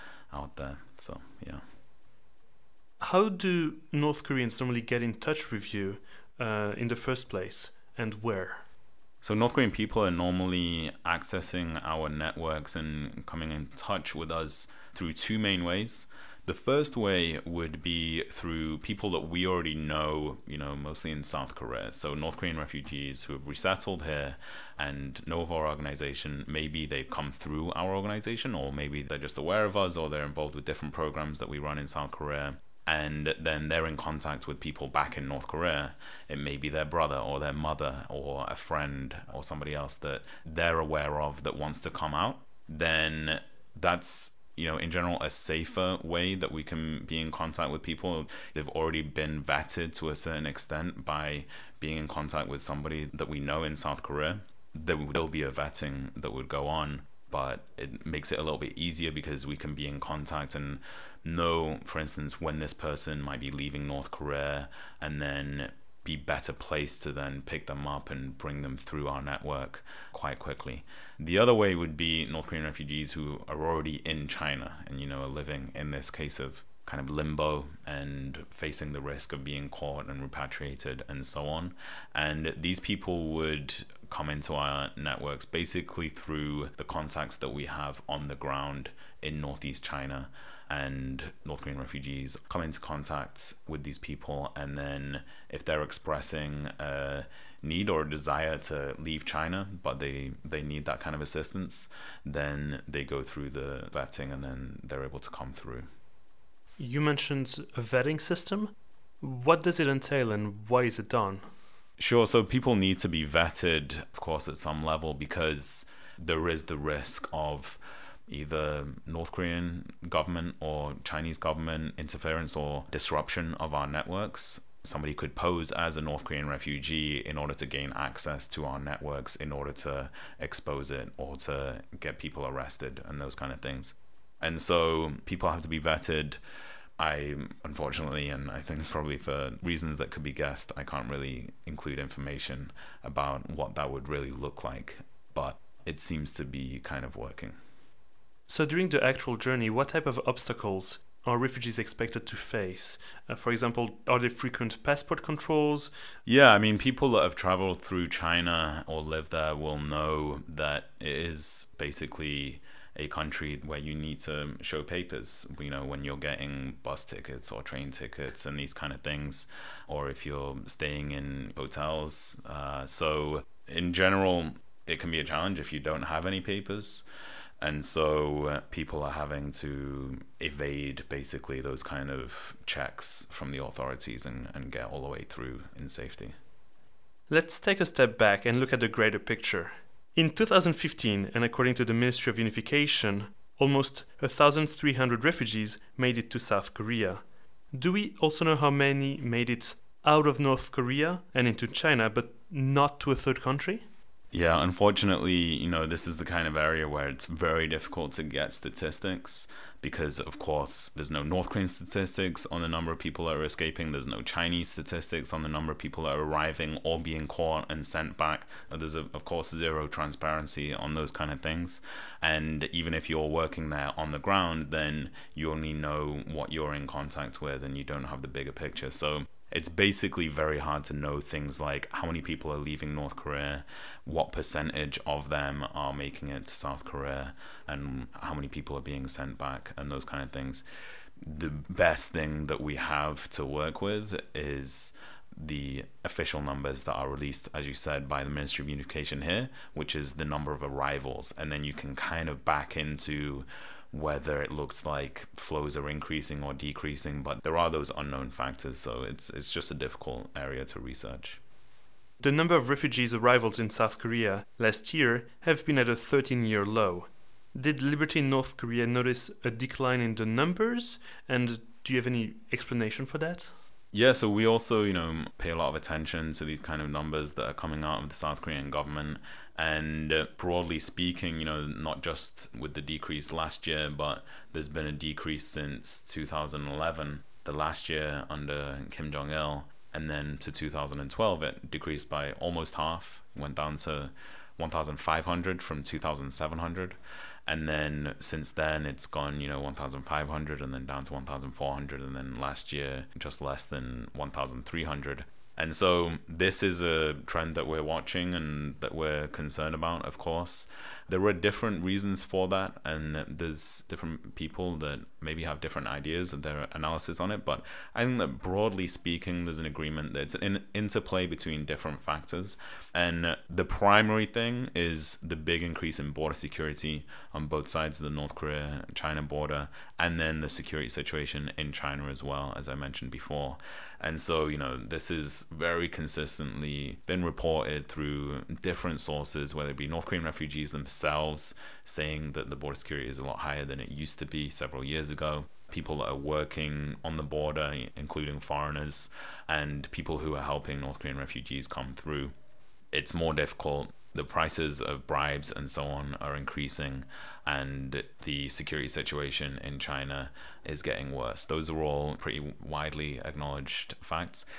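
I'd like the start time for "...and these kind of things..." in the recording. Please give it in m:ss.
2:48.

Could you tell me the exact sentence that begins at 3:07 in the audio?
Let's take a step back and look at the greater picture.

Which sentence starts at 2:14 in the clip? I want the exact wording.
And so people have to be vetted.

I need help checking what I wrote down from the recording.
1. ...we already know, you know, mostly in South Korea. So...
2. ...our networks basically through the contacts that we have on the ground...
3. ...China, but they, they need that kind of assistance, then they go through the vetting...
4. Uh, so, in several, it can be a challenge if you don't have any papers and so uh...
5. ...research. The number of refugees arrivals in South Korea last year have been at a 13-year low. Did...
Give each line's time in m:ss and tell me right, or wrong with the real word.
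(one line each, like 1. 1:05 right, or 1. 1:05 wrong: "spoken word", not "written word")
1. 0:19 right
2. 1:24 right
3. 1:39 right
4. 2:52 wrong: "general", not "several"
5. 4:20 right.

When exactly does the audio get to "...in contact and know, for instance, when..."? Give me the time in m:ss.
0:59.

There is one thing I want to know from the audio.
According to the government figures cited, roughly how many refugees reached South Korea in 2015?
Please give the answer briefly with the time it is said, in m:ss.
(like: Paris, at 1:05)
1,300, at 3:13.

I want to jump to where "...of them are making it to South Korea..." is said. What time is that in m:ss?
3:55.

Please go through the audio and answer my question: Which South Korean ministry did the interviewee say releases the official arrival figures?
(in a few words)
Ministry of Education.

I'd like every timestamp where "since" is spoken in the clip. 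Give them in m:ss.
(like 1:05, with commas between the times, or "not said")
4:45, 4:58.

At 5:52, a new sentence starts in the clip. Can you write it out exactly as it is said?
It's more difficult the prices of bribes and so on are increasing, and the security situation in China is getting worse.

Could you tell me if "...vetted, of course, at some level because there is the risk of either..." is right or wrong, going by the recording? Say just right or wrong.
right.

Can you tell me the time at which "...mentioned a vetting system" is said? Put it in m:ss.
1:47.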